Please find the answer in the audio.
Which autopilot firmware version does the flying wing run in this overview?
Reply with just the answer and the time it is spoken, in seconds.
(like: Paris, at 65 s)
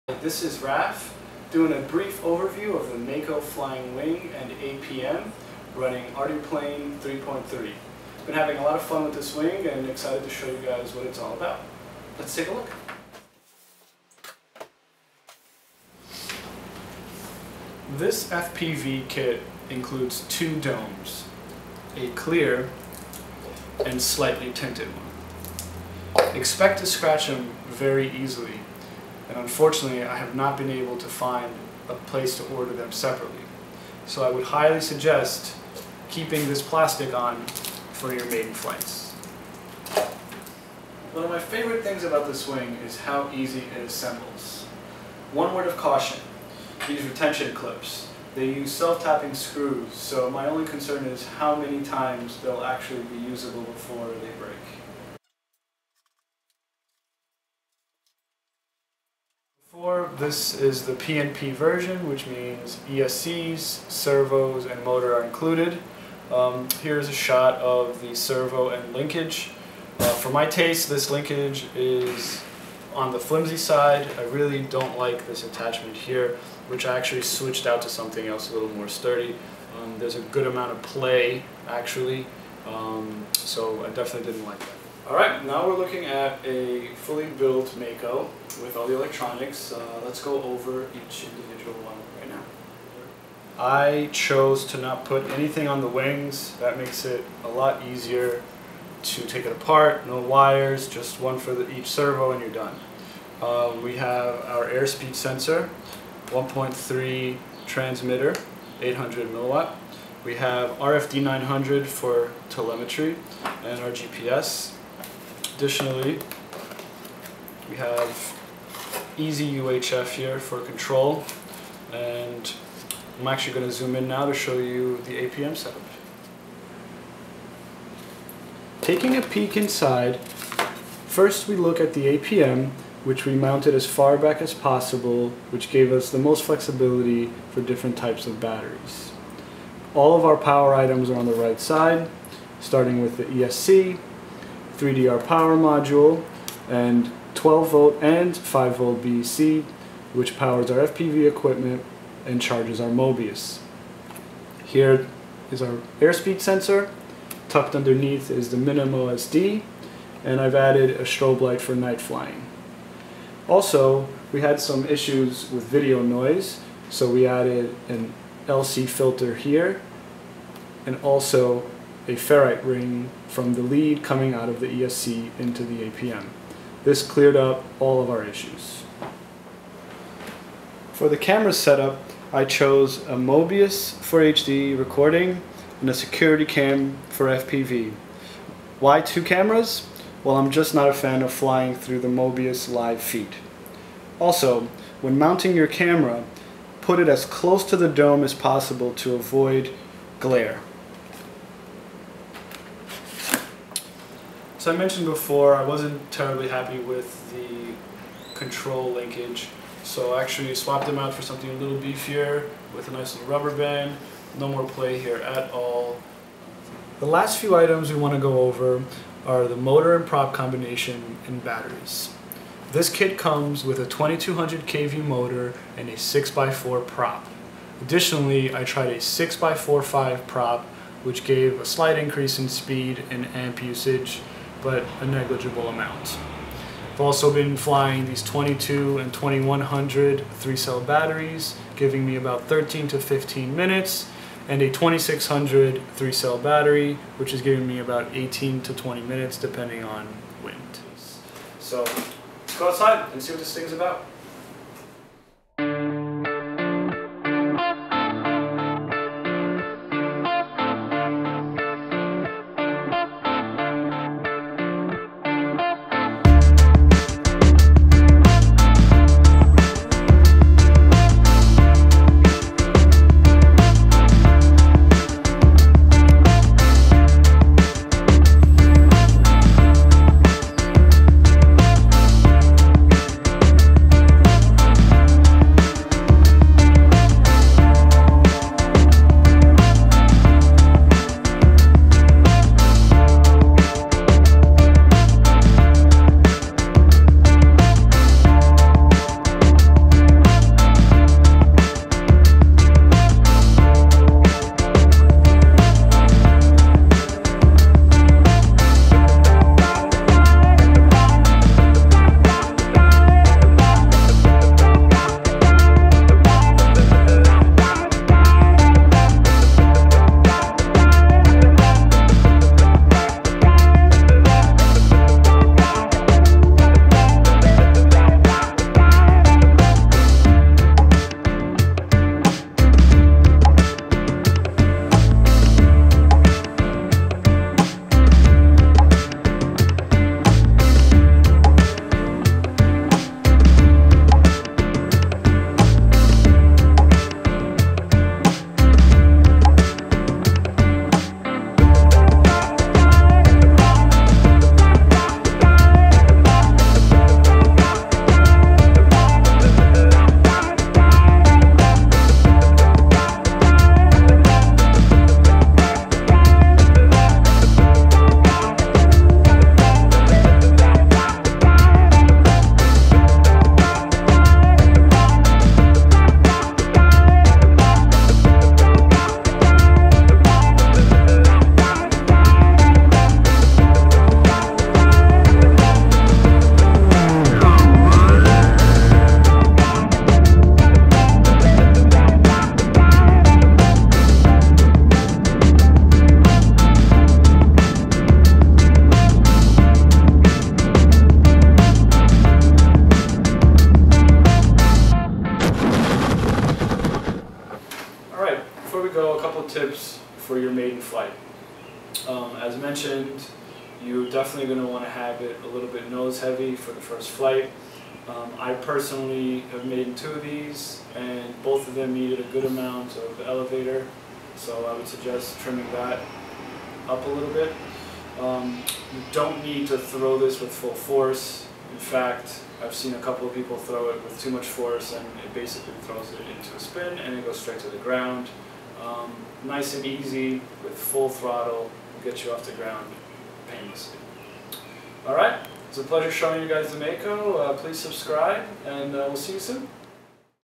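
Arduplane 3.3, at 6 s.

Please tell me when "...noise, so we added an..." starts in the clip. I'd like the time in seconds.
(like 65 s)
166 s.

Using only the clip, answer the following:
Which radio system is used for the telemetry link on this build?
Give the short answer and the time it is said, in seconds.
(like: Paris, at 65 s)
RFD 900, at 110 s.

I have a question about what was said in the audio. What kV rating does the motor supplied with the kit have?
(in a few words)
2200 kV.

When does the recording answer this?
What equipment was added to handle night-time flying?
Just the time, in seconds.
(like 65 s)
161 s.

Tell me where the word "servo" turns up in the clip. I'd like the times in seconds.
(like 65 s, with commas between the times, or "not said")
63 s, 68 s, 101 s.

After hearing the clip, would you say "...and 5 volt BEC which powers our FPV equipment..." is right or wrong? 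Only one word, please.
right.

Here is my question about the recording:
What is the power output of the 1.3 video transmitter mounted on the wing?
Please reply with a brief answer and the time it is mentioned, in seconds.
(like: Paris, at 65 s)
800 milliwatts, at 108 s.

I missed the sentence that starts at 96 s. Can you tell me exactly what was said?
That makes it a lot easier to take it apart.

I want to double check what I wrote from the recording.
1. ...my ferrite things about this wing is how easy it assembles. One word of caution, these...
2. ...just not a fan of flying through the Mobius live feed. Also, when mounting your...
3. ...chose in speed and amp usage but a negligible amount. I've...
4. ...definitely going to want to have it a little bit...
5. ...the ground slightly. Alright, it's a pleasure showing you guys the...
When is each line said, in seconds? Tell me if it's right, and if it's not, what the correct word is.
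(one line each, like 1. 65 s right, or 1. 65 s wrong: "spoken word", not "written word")
1. 41 s wrong: "favorite", not "ferrite"
2. 190 s right
3. 231 s wrong: "increase", not "chose"
4. 414 s right
5. 442 s wrong: "painlessly", not "slightly".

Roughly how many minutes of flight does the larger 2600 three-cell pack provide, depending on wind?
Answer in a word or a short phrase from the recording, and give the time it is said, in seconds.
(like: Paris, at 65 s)
18 to 20 minutes, at 248 s.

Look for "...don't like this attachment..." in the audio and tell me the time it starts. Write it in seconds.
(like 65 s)
74 s.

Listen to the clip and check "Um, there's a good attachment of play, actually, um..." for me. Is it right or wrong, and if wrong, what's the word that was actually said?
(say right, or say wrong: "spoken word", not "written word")
wrong: "amount", not "attachment".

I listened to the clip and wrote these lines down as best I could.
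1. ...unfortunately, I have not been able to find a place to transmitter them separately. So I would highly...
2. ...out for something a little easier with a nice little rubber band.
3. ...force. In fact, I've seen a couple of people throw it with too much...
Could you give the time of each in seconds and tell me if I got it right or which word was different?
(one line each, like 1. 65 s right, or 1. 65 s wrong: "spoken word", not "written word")
1. 29 s wrong: "order", not "transmitter"
2. 210 s wrong: "beefier", not "easier"
3. 430 s right.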